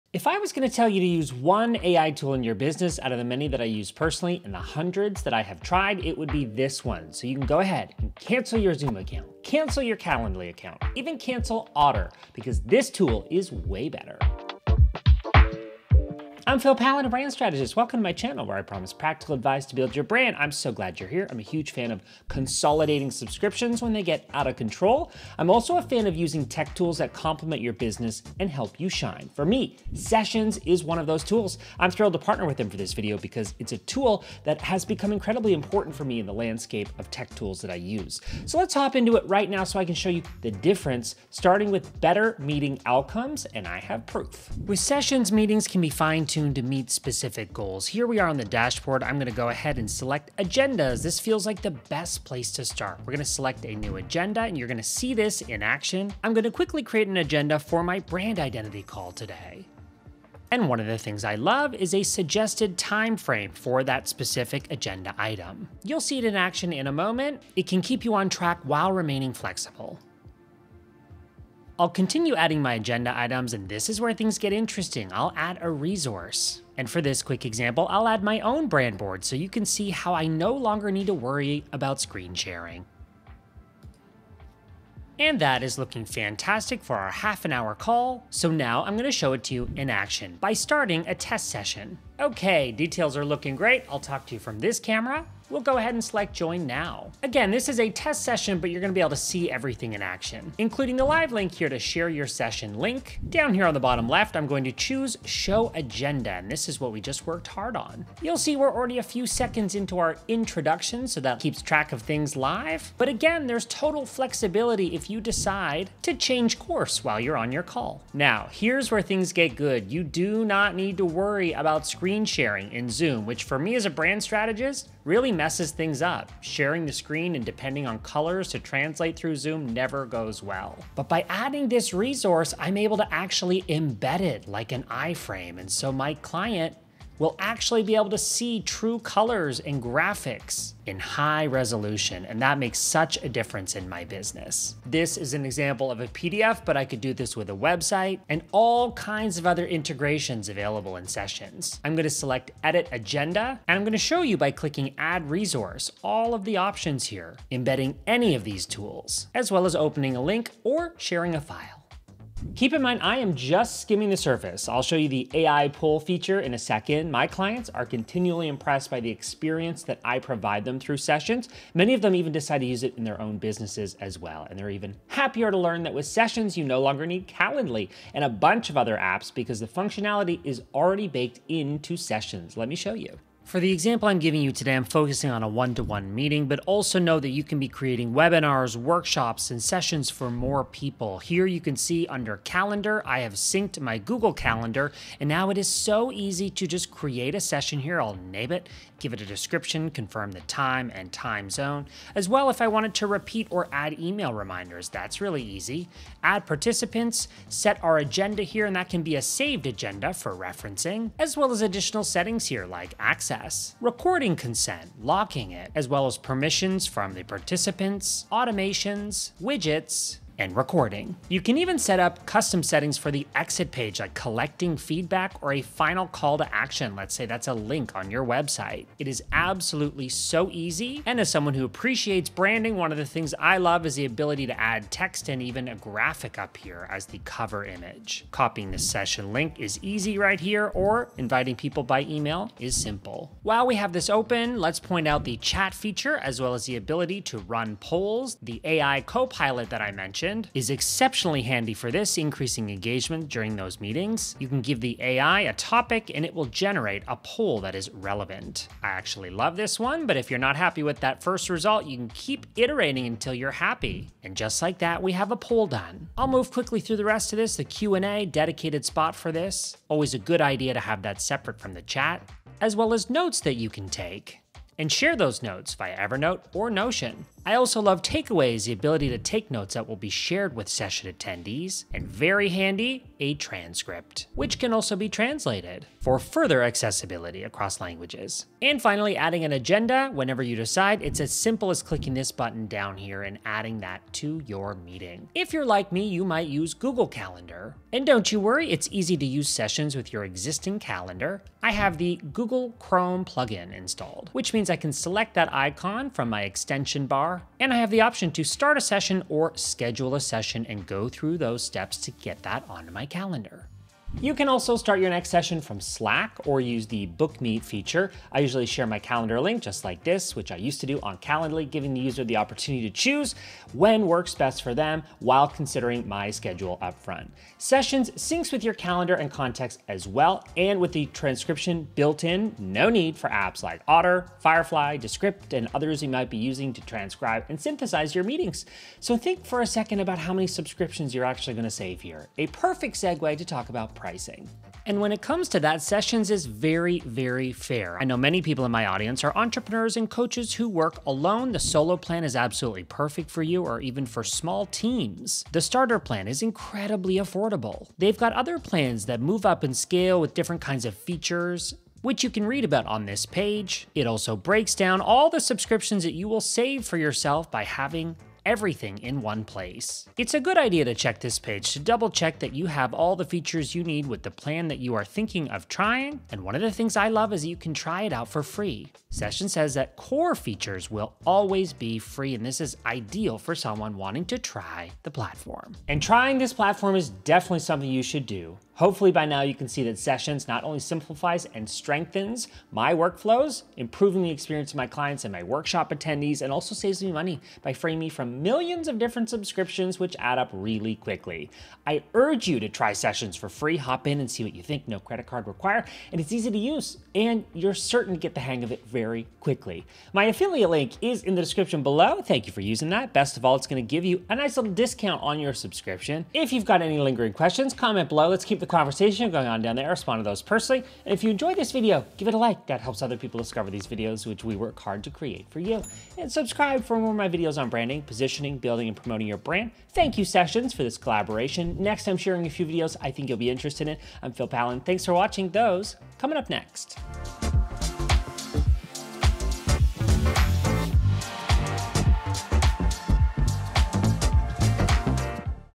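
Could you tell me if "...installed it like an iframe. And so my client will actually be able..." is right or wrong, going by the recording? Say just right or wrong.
wrong.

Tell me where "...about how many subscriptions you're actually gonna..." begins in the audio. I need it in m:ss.
5:39.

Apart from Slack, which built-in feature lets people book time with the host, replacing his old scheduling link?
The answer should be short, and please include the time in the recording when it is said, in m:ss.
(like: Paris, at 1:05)
BookMeet, at 5:17.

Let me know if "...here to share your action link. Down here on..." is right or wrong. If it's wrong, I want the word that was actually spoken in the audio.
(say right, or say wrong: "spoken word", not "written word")
wrong: "session", not "action".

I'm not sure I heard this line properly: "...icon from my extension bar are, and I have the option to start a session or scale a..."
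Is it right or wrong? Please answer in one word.
wrong.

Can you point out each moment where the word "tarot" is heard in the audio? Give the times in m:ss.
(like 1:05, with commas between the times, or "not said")
not said.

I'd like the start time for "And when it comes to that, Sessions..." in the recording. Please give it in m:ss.
5:44.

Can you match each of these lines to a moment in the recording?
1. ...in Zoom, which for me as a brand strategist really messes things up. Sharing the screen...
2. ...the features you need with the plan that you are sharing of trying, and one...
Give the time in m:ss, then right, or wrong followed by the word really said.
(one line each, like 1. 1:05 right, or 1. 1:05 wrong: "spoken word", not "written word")
1. 2:02 right
2. 6:13 wrong: "thinking", not "sharing".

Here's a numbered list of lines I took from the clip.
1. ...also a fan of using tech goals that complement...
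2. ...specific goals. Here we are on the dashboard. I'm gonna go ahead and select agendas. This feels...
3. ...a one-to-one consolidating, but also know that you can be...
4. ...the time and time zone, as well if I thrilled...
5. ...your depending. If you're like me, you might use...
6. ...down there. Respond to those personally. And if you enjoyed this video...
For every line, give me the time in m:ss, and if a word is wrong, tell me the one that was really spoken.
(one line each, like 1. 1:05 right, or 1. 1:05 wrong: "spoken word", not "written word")
1. 0:25 wrong: "tools", not "goals"
2. 0:46 right
3. 3:05 wrong: "meeting", not "consolidating"
4. 3:20 wrong: "wanted", not "thrilled"
5. 4:54 wrong: "meeting", not "depending"
6. 6:59 right.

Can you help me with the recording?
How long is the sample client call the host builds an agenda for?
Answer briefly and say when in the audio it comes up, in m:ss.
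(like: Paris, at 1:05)
Half an hour, at 1:27.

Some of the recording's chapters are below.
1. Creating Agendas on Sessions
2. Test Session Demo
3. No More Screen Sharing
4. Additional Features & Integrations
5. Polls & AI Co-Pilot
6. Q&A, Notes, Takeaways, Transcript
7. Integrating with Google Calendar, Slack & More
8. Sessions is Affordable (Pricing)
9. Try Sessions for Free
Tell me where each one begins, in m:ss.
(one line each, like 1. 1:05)
1. 0:44
2. 1:30
3. 2:00
4. 2:32
5. 4:03
6. 4:26
7. 5:13
8. 5:44
9. 6:25.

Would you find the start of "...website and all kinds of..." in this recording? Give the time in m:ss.
2:27.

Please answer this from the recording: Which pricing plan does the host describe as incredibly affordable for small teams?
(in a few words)
Starter plan.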